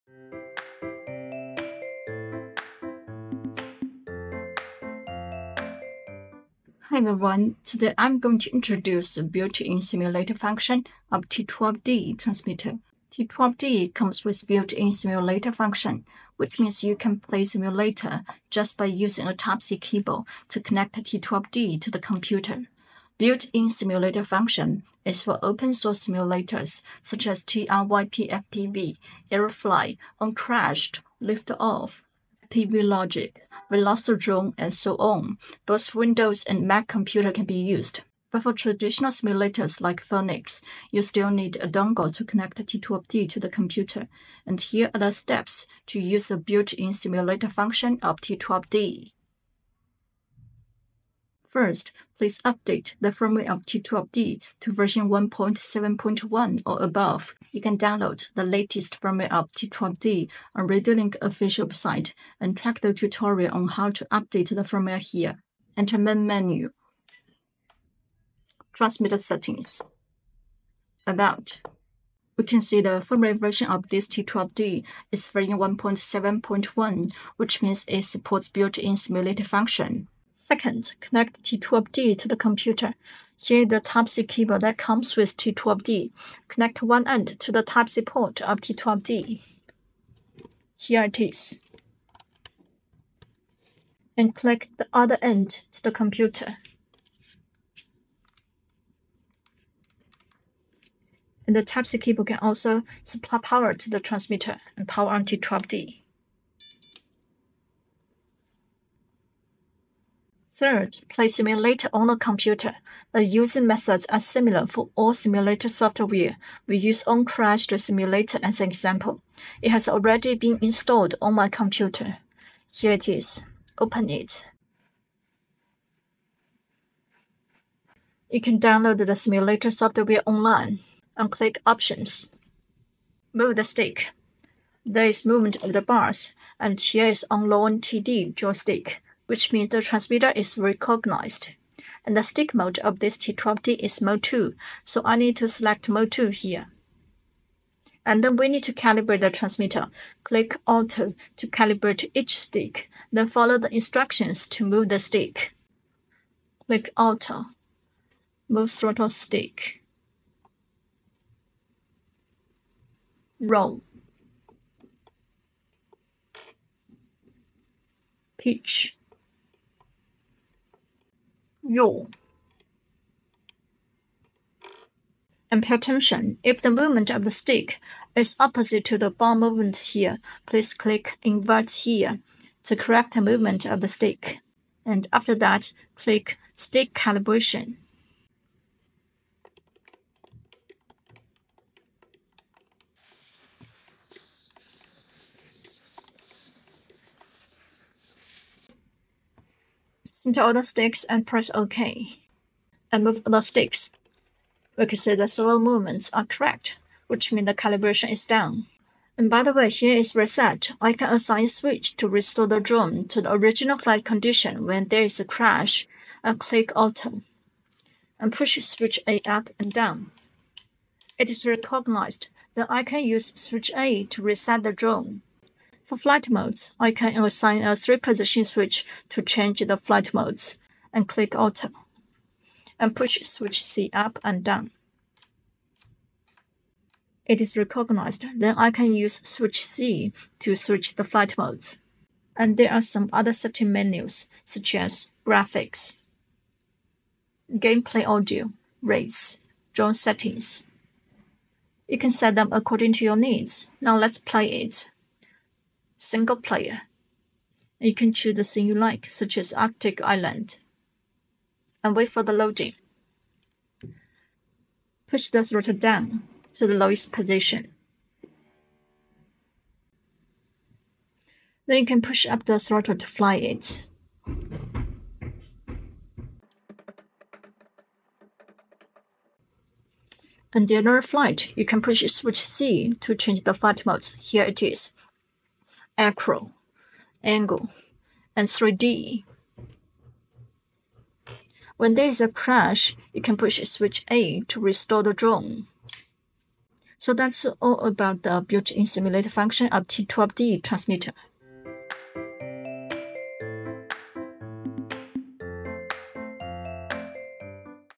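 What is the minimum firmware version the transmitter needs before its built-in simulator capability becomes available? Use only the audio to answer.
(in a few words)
1.7.1.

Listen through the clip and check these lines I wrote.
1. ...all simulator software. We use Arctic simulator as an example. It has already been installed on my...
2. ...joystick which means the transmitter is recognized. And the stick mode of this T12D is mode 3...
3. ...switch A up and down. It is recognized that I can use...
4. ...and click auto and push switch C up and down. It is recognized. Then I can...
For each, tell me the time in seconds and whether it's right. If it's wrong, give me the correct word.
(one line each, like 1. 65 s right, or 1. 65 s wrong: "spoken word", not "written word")
1. 114 s wrong: "Uncrashed", not "Arctic"
2. 138 s wrong: "2", not "3"
3. 218 s right
4. 230 s right.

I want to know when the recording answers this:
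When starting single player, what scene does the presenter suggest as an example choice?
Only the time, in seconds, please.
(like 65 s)
259 s.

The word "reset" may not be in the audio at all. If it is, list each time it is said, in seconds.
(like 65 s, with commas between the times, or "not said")
210 s, 224 s.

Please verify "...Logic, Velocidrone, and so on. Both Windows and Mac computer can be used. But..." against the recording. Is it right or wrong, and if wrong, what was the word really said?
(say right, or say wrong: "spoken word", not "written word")
right.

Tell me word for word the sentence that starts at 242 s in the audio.
And there are some other setting menus such as graphics, gameplay audio, race, drone settings.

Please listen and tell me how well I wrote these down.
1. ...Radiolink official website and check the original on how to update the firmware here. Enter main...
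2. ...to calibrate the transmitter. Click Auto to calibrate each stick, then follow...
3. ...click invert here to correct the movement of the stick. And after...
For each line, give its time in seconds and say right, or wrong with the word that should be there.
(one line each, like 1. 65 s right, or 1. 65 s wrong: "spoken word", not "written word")
1. 60 s wrong: "tutorial", not "original"
2. 148 s right
3. 180 s right.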